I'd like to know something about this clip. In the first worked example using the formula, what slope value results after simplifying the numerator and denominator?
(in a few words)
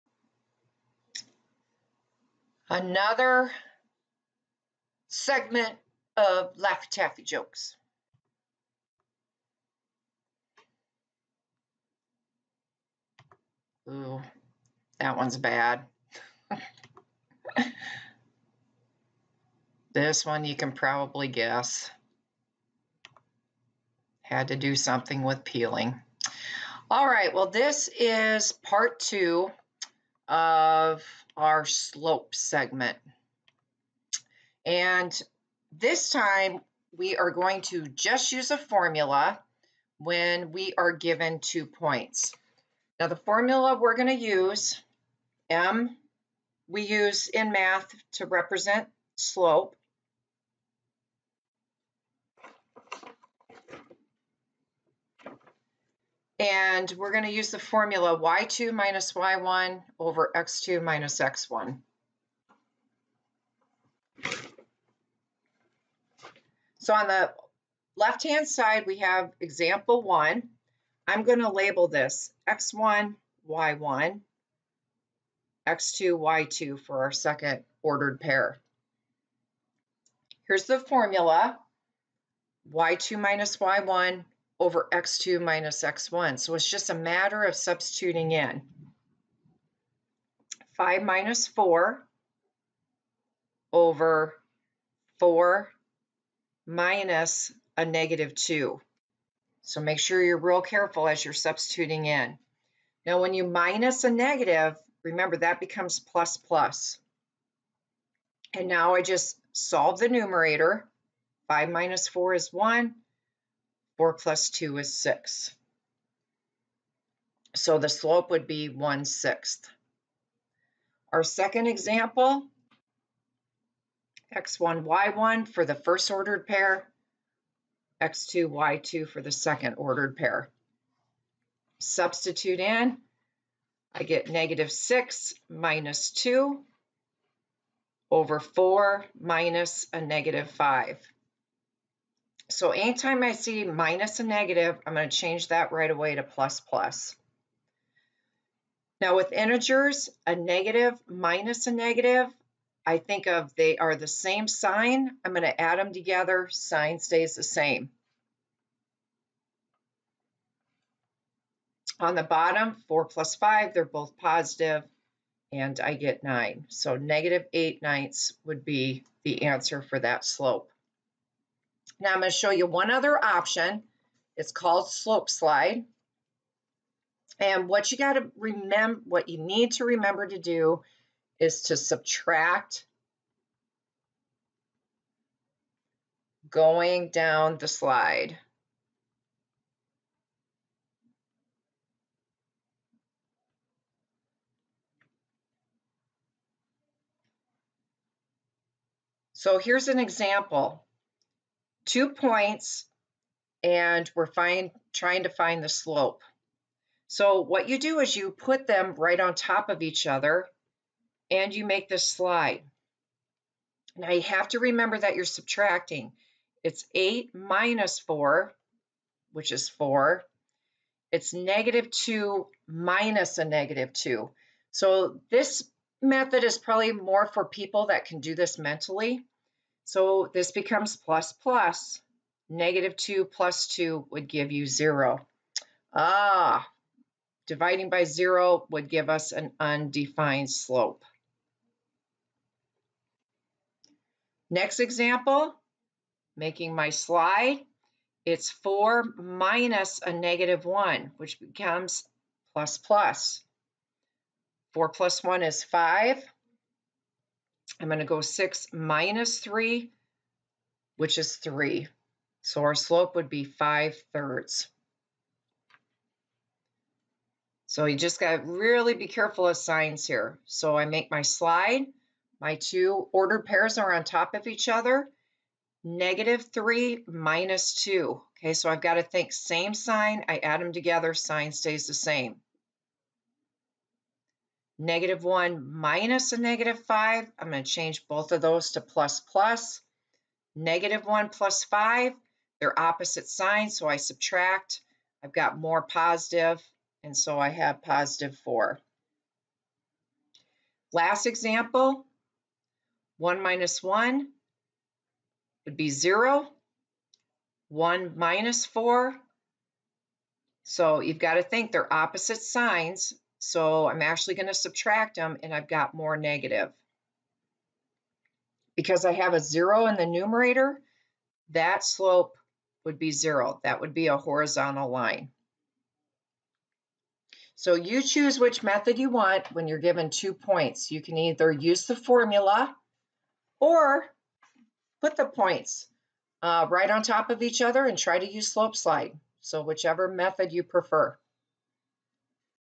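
1/6.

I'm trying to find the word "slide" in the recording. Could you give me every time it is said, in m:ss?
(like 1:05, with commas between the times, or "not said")
2:55, 3:07, 3:32, 4:06, 4:31, 5:38.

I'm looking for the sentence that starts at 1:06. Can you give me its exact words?
So on the left-hand side, we have example one.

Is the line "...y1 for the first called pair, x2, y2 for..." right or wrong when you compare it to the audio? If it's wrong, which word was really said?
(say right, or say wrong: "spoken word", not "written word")
wrong: "ordered", not "called".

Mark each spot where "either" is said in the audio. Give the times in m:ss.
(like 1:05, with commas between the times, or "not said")
5:31.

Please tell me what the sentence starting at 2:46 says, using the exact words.
So negative 8 ninths would be the answer for that slope.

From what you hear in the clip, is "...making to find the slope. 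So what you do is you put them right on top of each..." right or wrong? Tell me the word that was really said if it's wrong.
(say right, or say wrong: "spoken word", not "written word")
wrong: "trying", not "making".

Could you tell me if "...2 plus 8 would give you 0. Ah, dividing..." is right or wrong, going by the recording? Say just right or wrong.
wrong.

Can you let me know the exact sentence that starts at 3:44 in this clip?
So this method is probably more for people that can do this mentally.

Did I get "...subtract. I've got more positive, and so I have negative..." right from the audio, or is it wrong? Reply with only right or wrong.
wrong.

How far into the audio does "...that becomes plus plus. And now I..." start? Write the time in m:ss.
1:45.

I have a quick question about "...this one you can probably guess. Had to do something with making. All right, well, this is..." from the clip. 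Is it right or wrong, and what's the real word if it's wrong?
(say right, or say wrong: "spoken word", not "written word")
wrong: "peeling", not "making".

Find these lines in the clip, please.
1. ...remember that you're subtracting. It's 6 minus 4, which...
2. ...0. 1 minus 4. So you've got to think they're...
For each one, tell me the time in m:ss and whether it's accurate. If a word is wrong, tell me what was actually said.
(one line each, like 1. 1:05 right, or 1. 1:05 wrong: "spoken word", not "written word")
1. 3:34 wrong: "8", not "6"
2. 5:05 right.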